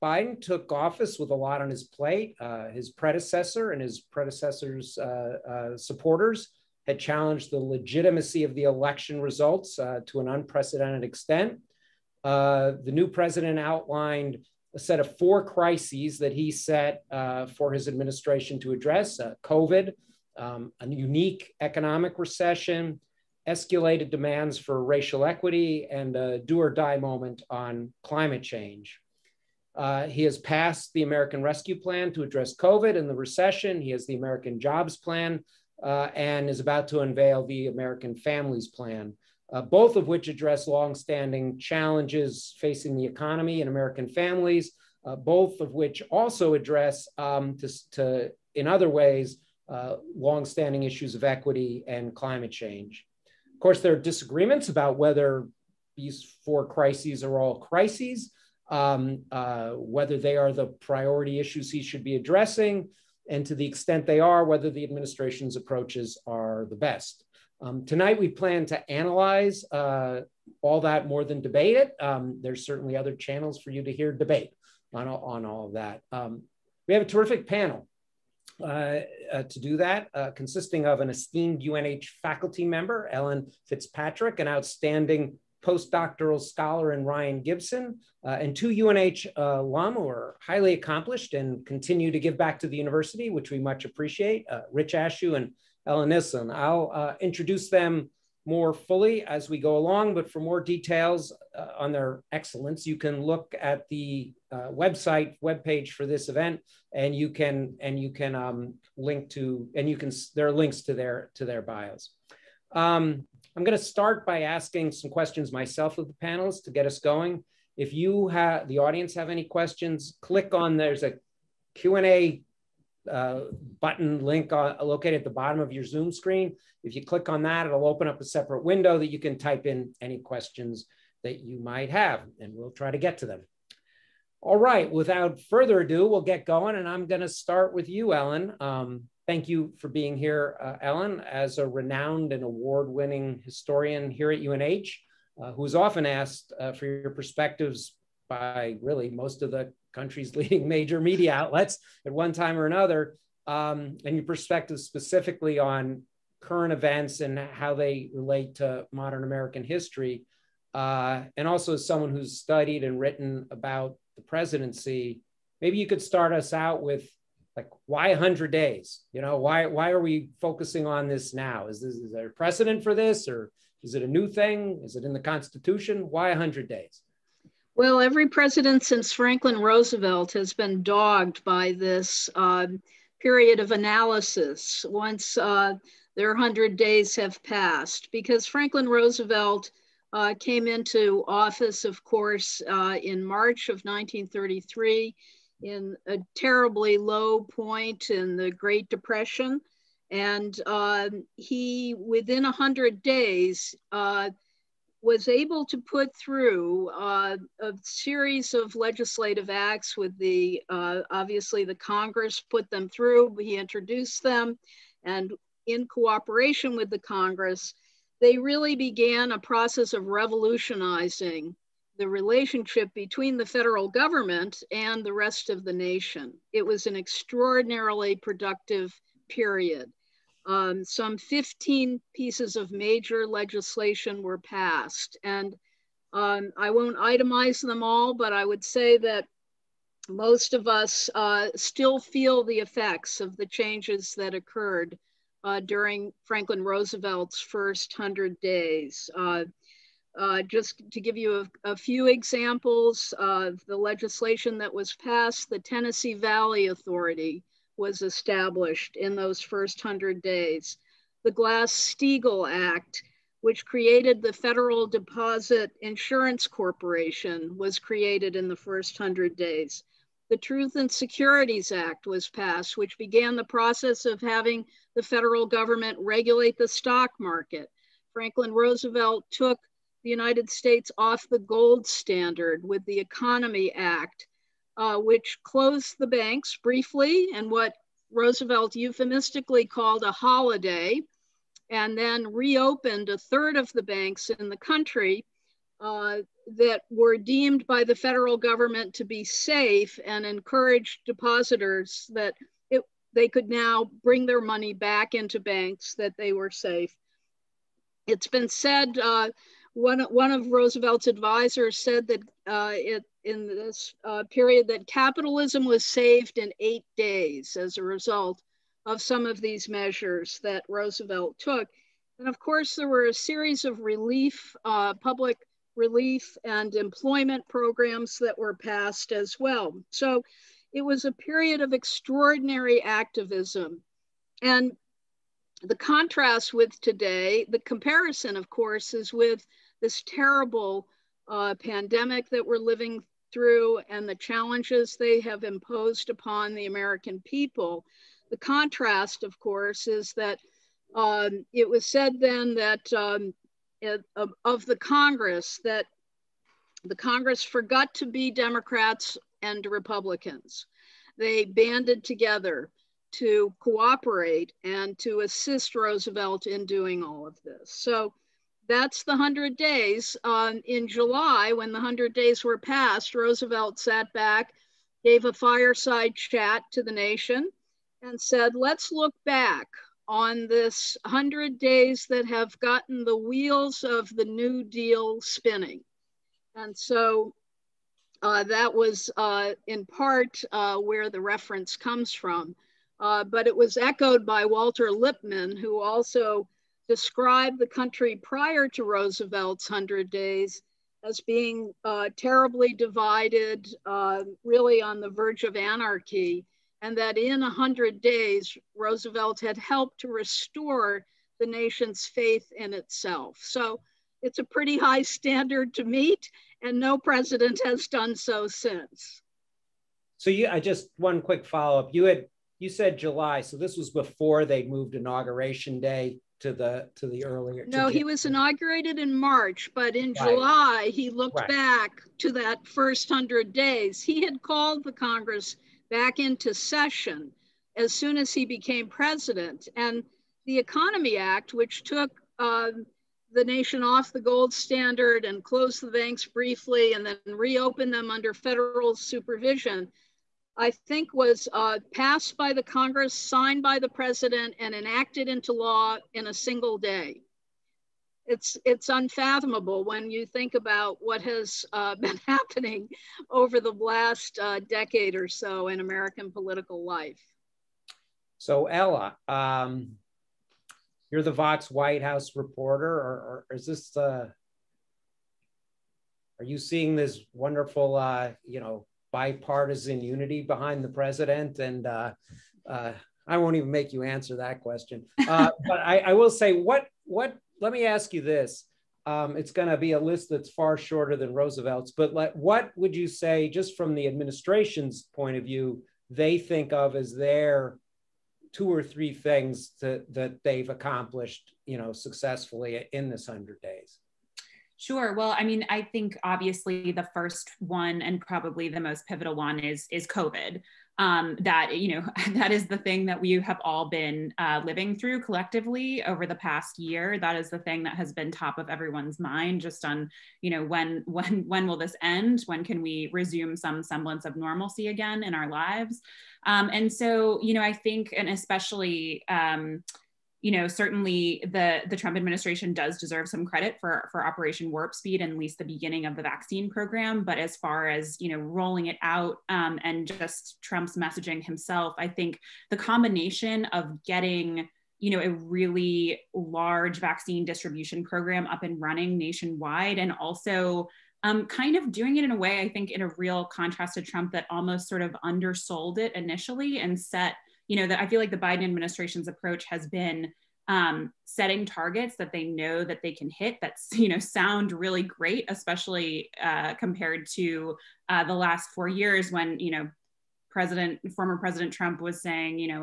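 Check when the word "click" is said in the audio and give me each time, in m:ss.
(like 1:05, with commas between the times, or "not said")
2:00, 2:07.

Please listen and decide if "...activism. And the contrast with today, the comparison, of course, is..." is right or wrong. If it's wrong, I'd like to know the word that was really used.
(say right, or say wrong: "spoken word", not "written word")
right.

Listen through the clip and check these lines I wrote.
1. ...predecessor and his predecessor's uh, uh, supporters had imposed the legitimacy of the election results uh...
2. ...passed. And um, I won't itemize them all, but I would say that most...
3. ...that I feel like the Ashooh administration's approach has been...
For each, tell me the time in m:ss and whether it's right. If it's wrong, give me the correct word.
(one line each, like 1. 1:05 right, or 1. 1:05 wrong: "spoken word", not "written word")
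1. 0:02 wrong: "challenged", not "imposed"
2. 3:54 right
3. 9:17 wrong: "Biden", not "Ashooh".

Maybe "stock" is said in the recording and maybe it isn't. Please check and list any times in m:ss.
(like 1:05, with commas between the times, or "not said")
4:36.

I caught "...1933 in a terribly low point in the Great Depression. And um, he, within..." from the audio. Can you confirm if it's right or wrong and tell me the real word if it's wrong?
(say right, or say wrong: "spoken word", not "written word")
right.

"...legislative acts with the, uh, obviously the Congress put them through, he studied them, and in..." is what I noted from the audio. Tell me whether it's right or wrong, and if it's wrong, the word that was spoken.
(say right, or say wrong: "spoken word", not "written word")
wrong: "introduced", not "studied".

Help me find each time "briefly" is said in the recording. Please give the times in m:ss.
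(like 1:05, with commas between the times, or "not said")
4:46, 7:26.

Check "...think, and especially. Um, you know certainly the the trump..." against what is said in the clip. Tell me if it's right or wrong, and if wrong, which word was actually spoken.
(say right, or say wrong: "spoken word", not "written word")
right.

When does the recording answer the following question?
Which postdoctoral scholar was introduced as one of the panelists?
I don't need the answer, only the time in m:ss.
1:27.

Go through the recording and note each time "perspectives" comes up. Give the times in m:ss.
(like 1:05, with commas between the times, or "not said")
2:27, 2:34.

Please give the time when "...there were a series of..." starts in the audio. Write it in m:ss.
5:22.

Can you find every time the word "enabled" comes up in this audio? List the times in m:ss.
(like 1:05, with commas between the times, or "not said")
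not said.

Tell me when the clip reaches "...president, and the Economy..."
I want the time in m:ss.
7:18.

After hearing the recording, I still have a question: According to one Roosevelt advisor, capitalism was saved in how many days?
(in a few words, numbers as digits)
8.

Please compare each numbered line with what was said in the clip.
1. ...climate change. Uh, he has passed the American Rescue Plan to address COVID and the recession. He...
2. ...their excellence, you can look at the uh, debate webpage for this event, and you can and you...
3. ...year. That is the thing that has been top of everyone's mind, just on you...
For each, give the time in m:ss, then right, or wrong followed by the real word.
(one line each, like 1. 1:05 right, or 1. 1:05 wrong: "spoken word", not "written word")
1. 0:28 right
2. 1:41 wrong: "website", not "debate"
3. 8:36 right.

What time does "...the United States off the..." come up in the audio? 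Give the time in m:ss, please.
4:40.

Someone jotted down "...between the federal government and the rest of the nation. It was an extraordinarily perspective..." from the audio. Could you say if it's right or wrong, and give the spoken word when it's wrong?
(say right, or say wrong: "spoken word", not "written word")
wrong: "productive", not "perspective".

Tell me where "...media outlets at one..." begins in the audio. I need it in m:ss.
2:31.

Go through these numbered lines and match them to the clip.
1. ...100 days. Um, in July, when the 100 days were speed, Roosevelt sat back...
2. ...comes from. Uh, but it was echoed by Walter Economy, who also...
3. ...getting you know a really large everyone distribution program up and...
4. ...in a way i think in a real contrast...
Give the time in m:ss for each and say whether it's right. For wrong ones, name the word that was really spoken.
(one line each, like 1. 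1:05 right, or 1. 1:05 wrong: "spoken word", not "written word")
1. 6:09 wrong: "passed", not "speed"
2. 6:31 wrong: "Lippmann", not "Economy"
3. 9:04 wrong: "vaccine", not "everyone"
4. 9:12 right.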